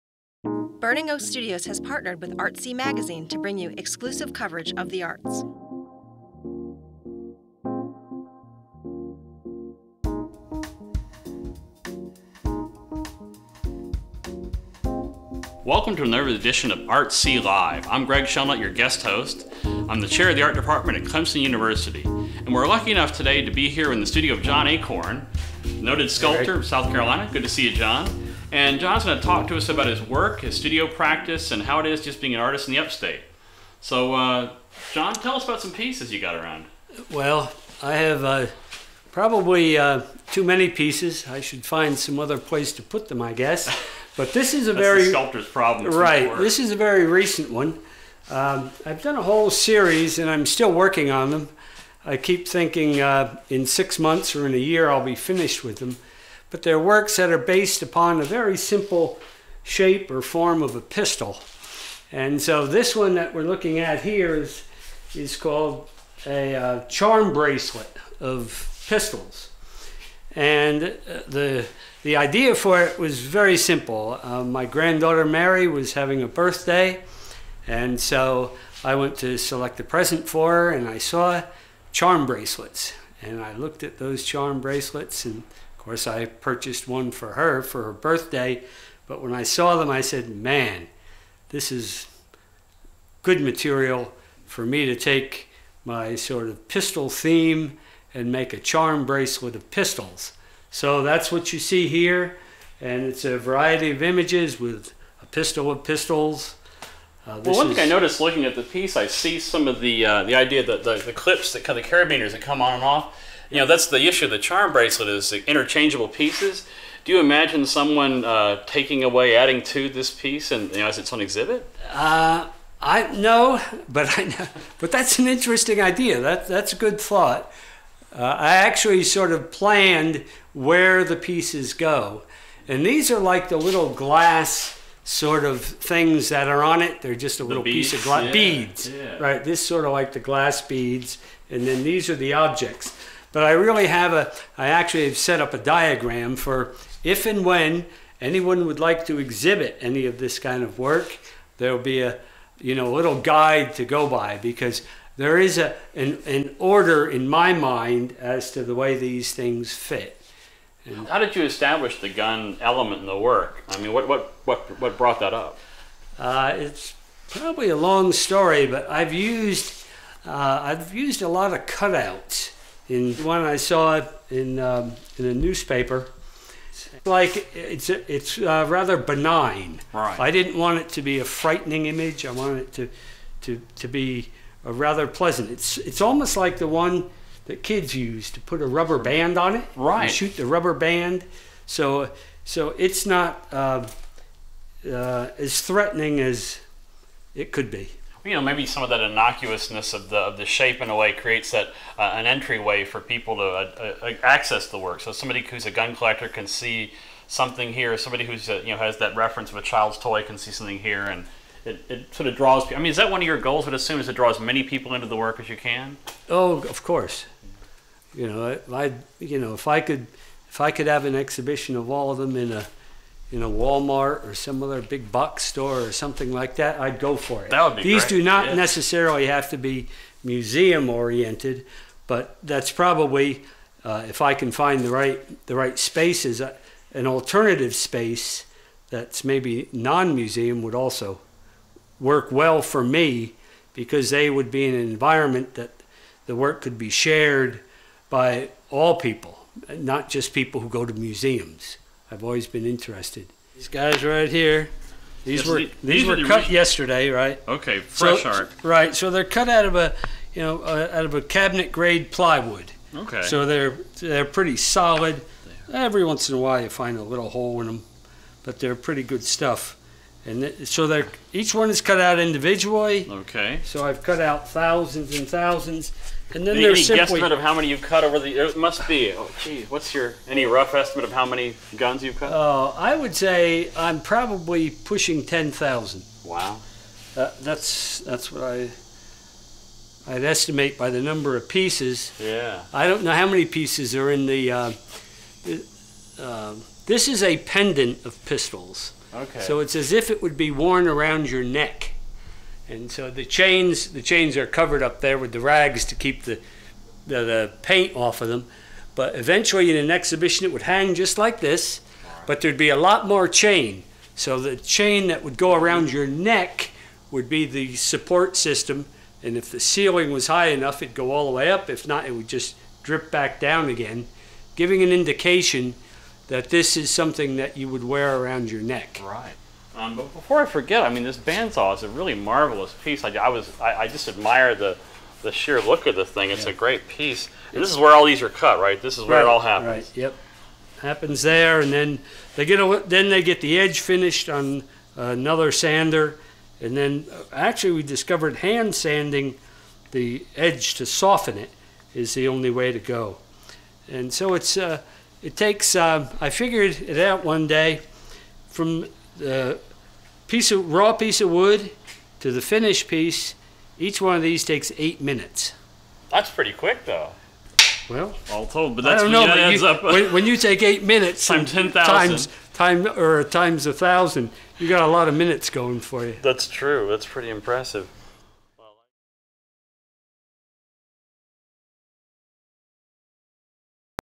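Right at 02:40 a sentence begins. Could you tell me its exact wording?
And How did you establish the gun element in the work?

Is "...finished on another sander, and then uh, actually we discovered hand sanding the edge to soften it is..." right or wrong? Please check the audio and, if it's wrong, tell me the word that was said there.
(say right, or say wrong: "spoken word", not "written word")
right.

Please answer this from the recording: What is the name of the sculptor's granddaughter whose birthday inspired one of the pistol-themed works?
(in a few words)
Mary.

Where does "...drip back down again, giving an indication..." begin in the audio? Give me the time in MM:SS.
05:22.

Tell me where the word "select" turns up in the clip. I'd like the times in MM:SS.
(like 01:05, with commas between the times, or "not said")
01:19.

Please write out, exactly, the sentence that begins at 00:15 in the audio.
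Welcome to another edition of Artsee Live.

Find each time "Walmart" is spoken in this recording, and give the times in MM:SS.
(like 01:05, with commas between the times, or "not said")
03:43.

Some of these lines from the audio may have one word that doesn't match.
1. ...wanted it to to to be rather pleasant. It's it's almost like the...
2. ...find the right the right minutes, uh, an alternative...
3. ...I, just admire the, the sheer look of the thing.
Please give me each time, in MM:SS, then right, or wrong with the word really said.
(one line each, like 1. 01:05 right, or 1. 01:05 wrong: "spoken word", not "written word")
1. 03:02 right
2. 03:54 wrong: "spaces", not "minutes"
3. 05:33 right.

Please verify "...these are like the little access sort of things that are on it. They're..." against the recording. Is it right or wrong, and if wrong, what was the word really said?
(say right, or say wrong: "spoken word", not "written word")
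wrong: "glass", not "access".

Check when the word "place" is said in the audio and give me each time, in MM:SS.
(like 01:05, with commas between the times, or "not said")
00:42.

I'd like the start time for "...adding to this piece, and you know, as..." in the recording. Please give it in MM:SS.
01:59.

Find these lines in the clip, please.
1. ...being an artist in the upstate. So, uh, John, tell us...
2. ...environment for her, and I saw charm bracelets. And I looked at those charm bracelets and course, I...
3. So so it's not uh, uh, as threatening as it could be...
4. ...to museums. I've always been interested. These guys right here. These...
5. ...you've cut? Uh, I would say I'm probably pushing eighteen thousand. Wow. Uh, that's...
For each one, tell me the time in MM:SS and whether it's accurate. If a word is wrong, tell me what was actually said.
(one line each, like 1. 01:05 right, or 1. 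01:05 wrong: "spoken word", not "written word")
1. 00:32 right
2. 01:19 wrong: "present", not "environment"
3. 03:11 right
4. 04:10 right
5. 04:42 wrong: "ten", not "eighteen".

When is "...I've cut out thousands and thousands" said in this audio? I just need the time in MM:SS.
04:33.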